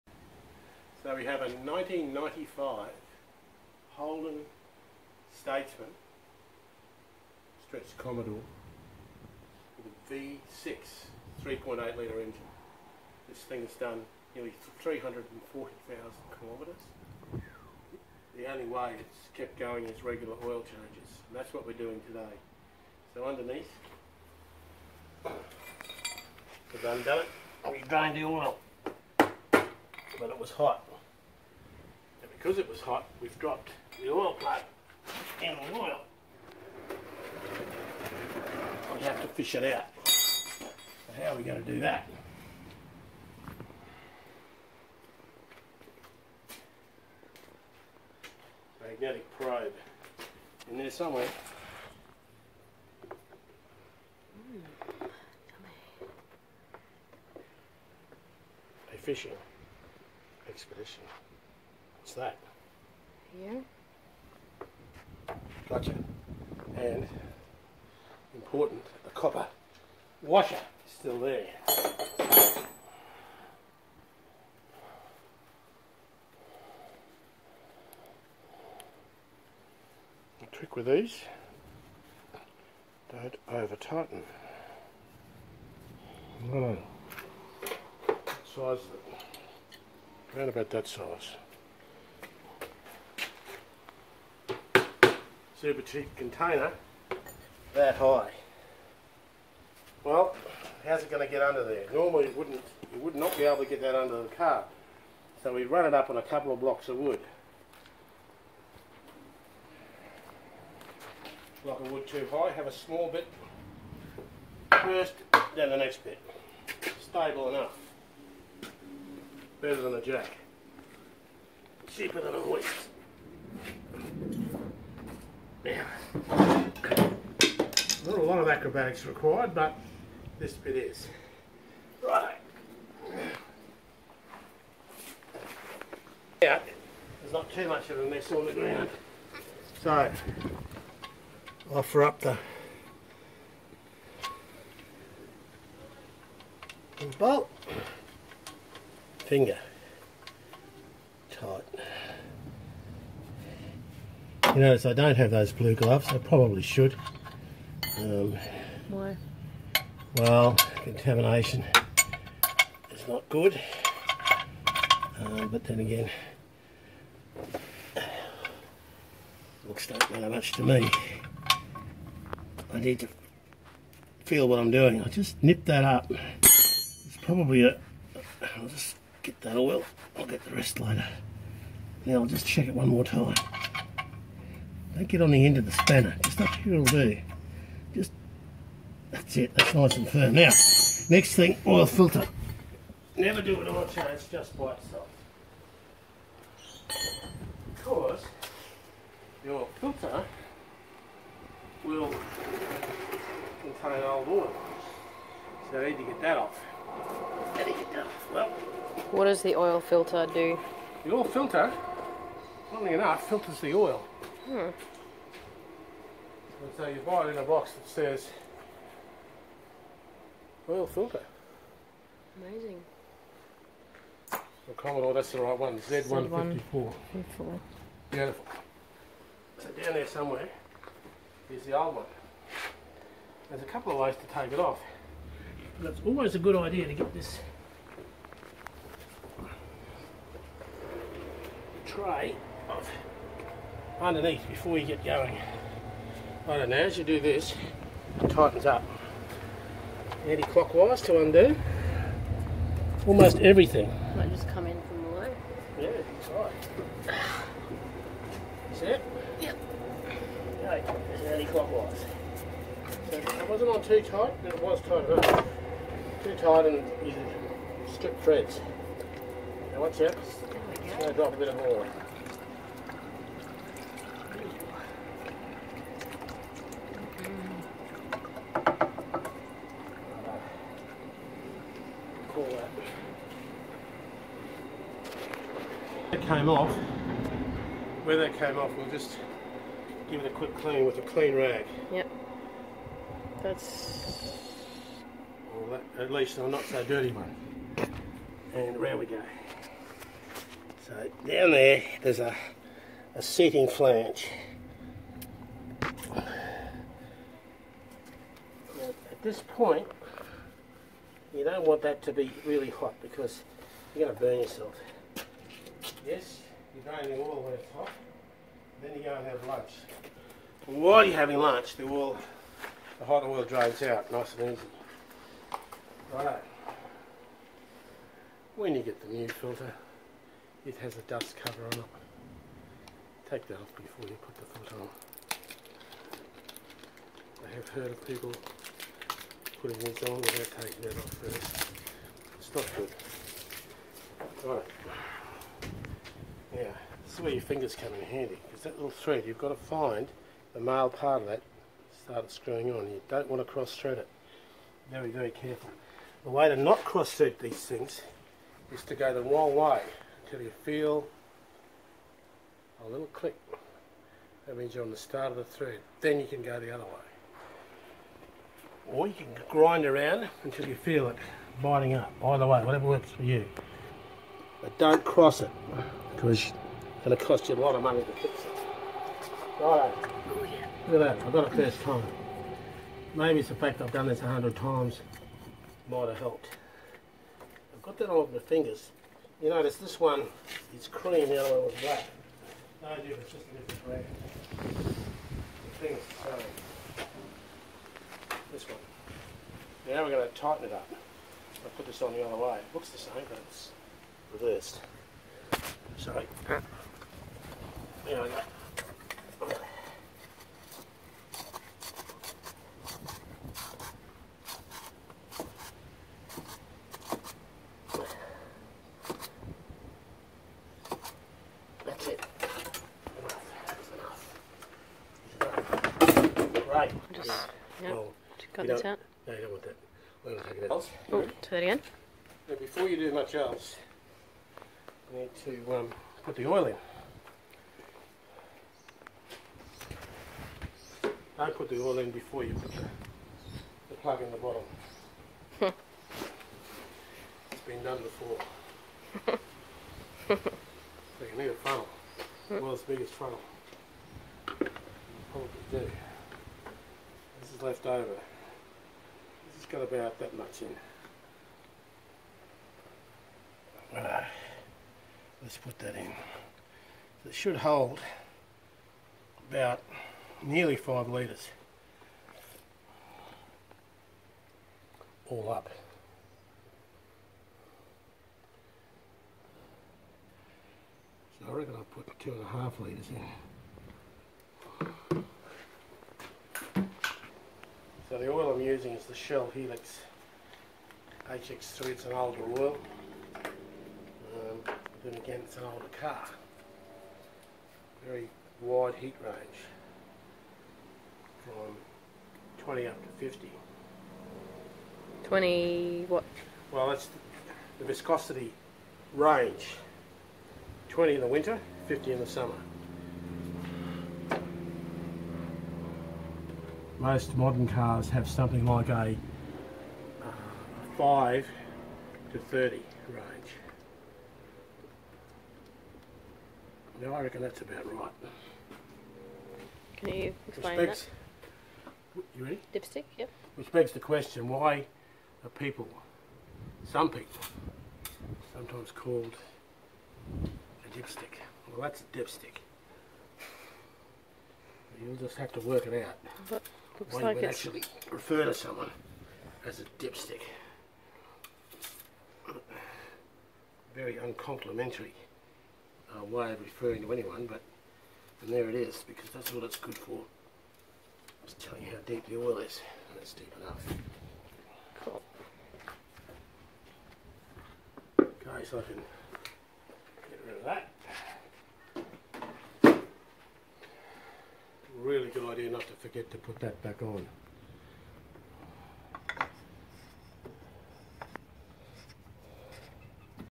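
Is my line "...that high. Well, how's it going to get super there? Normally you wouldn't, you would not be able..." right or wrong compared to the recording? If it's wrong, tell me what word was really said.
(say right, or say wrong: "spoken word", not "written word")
wrong: "under", not "super".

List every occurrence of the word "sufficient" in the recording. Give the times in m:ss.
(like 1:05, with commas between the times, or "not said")
not said.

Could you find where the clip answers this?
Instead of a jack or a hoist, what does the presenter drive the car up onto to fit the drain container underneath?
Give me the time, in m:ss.
1:46.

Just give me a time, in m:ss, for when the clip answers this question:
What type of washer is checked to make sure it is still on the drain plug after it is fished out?
1:09.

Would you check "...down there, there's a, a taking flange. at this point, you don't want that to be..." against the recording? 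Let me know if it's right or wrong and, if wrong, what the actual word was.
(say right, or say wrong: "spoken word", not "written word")
wrong: "seating", not "taking".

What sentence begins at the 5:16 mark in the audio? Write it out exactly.
Yes, you drain it all the way to the top, then you go and have lunch.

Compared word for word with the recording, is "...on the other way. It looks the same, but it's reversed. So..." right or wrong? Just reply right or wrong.
right.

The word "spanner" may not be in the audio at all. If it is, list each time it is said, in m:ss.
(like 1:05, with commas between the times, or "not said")
3:05.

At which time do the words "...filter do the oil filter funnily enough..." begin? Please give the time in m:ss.
3:29.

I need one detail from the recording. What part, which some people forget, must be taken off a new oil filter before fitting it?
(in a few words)
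dust cover.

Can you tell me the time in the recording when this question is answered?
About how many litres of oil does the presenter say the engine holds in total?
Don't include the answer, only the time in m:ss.
7:50.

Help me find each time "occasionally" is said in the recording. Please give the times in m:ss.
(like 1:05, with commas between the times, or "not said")
not said.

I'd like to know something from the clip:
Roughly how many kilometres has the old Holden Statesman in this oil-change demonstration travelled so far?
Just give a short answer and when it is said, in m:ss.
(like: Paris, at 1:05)
nearly 340,000, at 0:14.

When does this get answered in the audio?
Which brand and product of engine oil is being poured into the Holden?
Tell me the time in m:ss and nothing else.
8:09.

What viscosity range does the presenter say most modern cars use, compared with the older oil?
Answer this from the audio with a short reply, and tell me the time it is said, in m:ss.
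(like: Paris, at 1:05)
5 to 30, at 8:40.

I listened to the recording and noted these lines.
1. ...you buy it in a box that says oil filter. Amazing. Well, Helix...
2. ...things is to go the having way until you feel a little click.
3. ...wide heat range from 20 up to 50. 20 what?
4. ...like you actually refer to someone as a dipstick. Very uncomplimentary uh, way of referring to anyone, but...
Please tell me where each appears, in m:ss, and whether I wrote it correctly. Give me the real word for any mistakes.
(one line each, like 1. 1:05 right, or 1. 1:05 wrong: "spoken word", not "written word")
1. 3:36 wrong: "Commodore", not "Helix"
2. 5:57 wrong: "wrong", not "having"
3. 8:18 right
4. 9:07 right.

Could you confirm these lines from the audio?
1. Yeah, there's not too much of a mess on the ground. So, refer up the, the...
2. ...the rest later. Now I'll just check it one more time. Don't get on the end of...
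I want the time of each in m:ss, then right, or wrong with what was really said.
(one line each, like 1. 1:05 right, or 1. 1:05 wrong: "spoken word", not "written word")
1. 2:16 wrong: "offer", not "refer"
2. 3:00 right.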